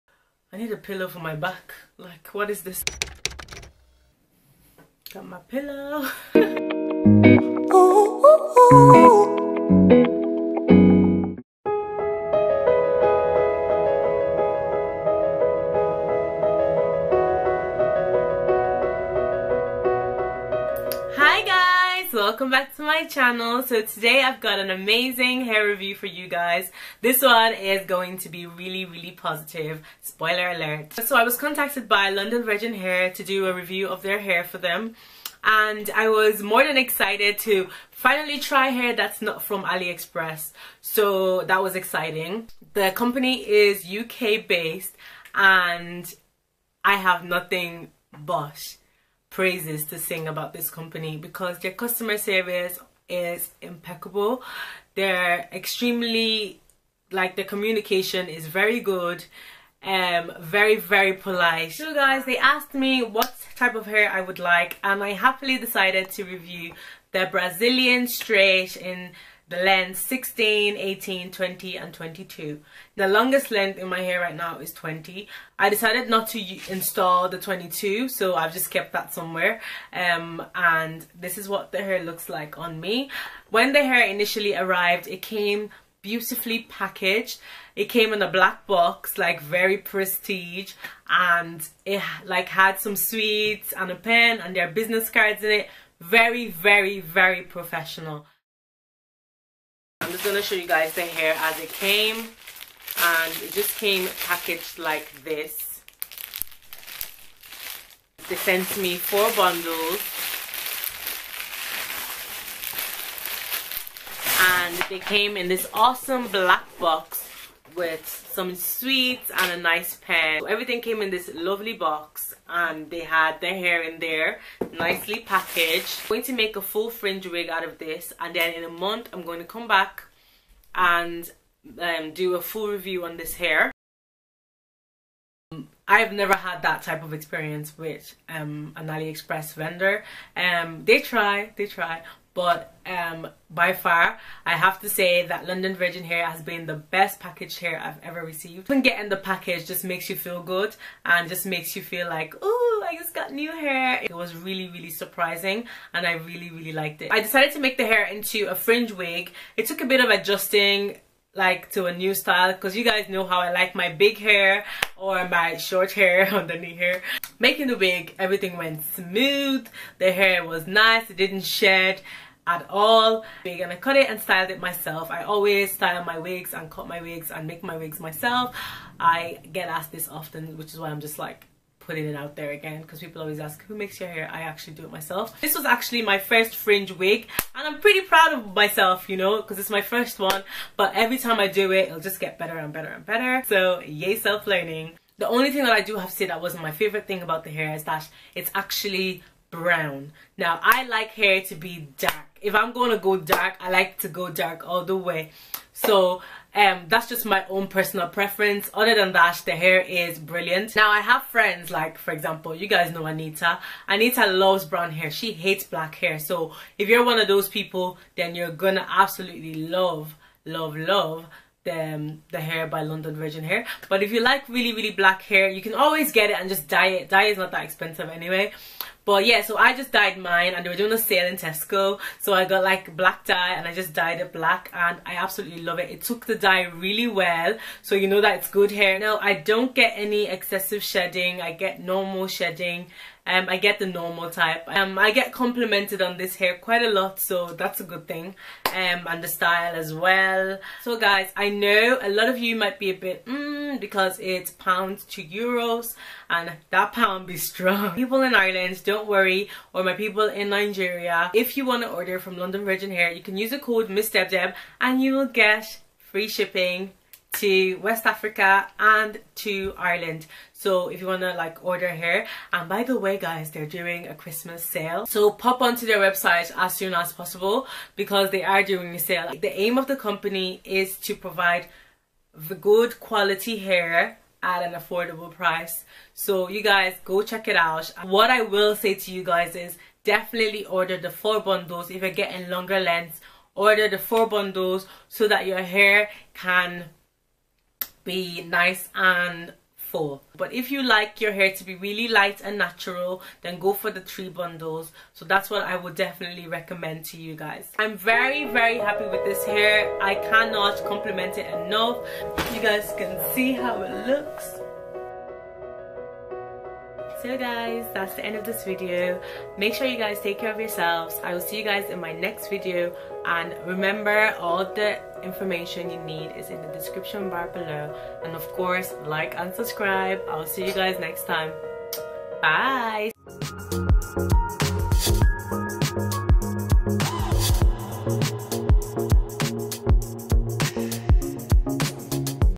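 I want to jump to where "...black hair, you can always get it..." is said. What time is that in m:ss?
3:44.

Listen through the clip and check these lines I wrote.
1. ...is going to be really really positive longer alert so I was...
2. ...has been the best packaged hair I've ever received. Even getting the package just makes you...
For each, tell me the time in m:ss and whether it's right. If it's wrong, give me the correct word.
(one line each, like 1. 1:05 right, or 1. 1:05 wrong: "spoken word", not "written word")
1. 0:27 wrong: "spoiler", not "longer"
2. 2:26 right.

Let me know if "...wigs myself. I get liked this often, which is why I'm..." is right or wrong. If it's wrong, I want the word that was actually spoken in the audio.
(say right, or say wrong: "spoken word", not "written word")
wrong: "asked", not "liked".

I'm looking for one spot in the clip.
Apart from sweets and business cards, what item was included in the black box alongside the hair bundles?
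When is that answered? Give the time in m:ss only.
1:33.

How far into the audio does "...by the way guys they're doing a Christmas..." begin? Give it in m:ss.
4:32.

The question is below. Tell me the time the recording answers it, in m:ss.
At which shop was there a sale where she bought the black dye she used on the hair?
3:51.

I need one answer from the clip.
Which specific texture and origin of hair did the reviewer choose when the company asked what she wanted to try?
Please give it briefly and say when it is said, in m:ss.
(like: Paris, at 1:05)
Brazilian straight, at 1:07.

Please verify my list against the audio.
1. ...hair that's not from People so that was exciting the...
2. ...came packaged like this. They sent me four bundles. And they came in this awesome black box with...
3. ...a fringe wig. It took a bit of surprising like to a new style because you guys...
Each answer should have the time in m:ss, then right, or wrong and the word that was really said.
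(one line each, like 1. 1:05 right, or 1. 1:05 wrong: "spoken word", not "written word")
1. 0:38 wrong: "AliExpress", not "People"
2. 1:43 right
3. 2:38 wrong: "adjusting", not "surprising".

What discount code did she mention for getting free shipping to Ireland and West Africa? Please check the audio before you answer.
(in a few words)
MsDebDeb.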